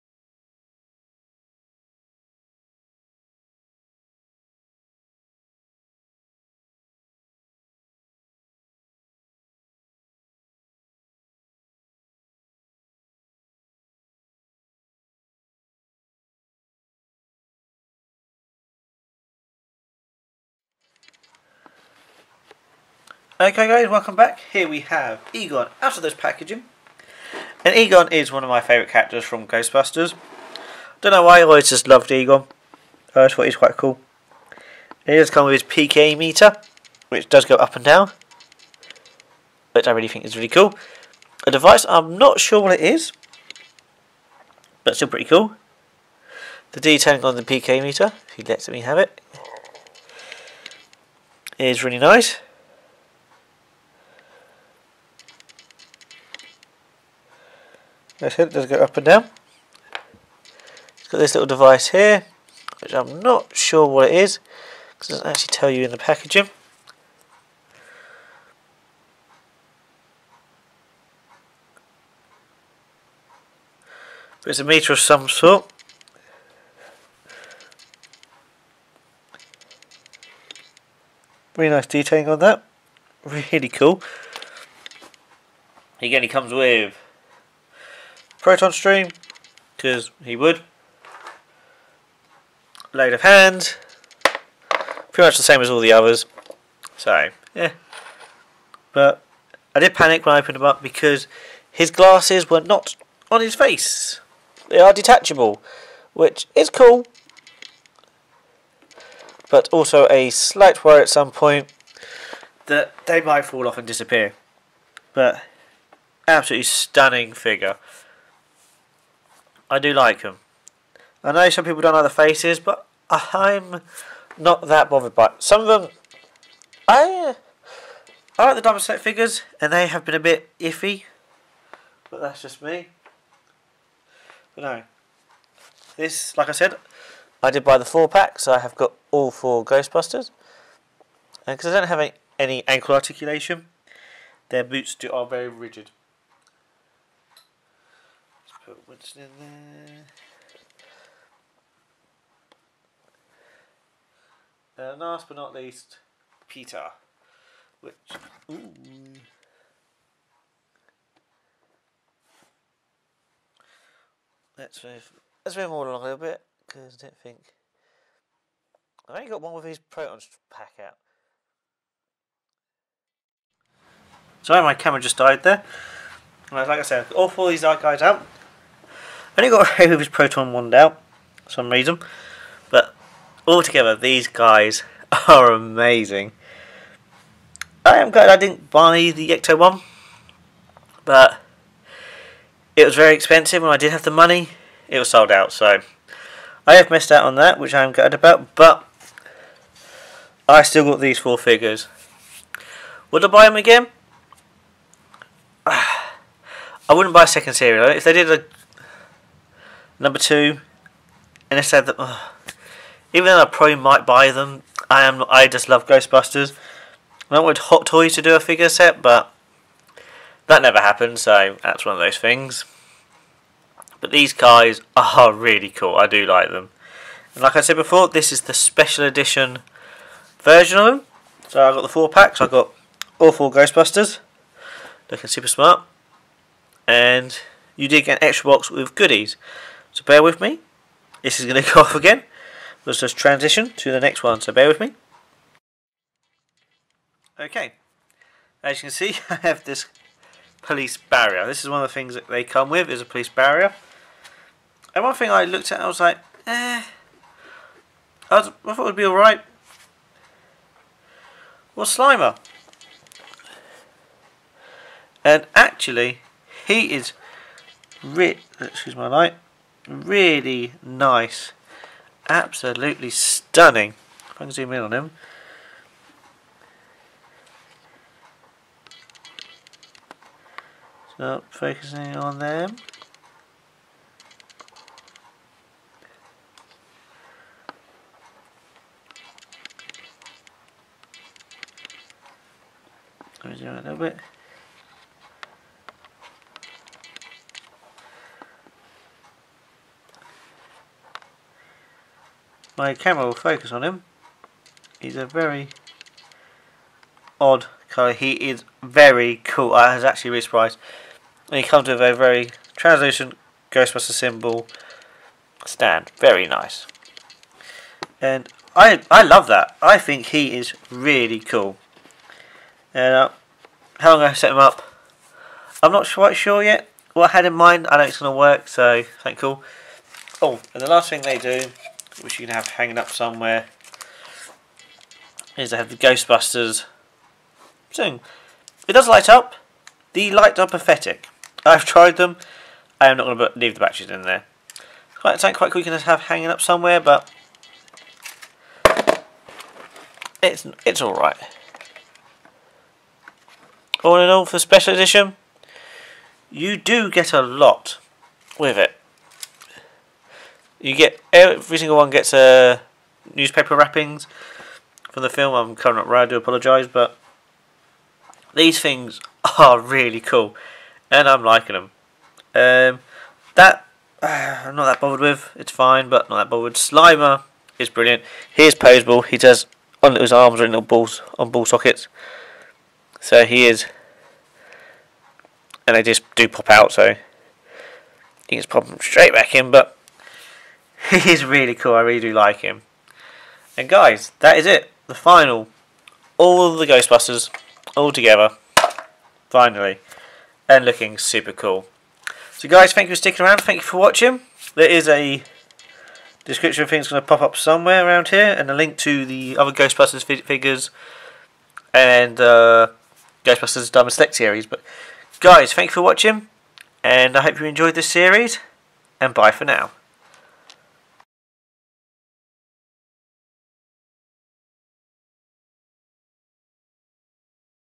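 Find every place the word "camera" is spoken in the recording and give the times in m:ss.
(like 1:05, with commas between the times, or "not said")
2:54, 5:02.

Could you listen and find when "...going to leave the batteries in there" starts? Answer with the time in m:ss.
5:43.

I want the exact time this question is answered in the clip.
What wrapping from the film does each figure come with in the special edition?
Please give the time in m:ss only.
6:03.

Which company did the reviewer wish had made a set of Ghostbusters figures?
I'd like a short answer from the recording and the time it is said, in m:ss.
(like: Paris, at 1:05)
Hot Toys, at 3:37.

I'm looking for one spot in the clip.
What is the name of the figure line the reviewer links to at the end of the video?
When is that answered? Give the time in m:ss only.
6:53.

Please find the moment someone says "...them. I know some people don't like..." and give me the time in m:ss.
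2:00.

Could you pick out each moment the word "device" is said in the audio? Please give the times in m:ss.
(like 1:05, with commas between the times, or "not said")
0:41, 1:01.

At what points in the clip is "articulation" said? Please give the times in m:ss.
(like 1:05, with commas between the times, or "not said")
2:22.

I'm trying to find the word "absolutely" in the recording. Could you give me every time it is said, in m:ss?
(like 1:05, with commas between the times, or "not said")
1:56, 4:32.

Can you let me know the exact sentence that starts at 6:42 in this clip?
So guys, thank you for sticking around.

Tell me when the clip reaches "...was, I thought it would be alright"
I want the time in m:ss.
4:18.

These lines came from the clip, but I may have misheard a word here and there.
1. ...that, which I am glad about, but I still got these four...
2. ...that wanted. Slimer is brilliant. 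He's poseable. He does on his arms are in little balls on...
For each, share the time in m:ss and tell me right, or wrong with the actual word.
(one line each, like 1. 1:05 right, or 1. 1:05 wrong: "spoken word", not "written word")
1. 3:17 right
2. 6:16 wrong: "bothered", not "wanted".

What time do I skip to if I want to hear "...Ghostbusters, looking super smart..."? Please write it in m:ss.
3:53.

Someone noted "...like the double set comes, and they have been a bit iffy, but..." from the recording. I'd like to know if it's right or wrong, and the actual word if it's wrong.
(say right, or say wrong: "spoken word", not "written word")
wrong: "figures", not "comes".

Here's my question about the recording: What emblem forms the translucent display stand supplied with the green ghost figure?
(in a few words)
Ghostbuster symbol.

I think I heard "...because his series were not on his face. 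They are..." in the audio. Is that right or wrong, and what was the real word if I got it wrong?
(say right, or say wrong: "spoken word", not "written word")
wrong: "glasses", not "series".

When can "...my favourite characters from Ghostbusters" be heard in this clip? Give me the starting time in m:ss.
0:28.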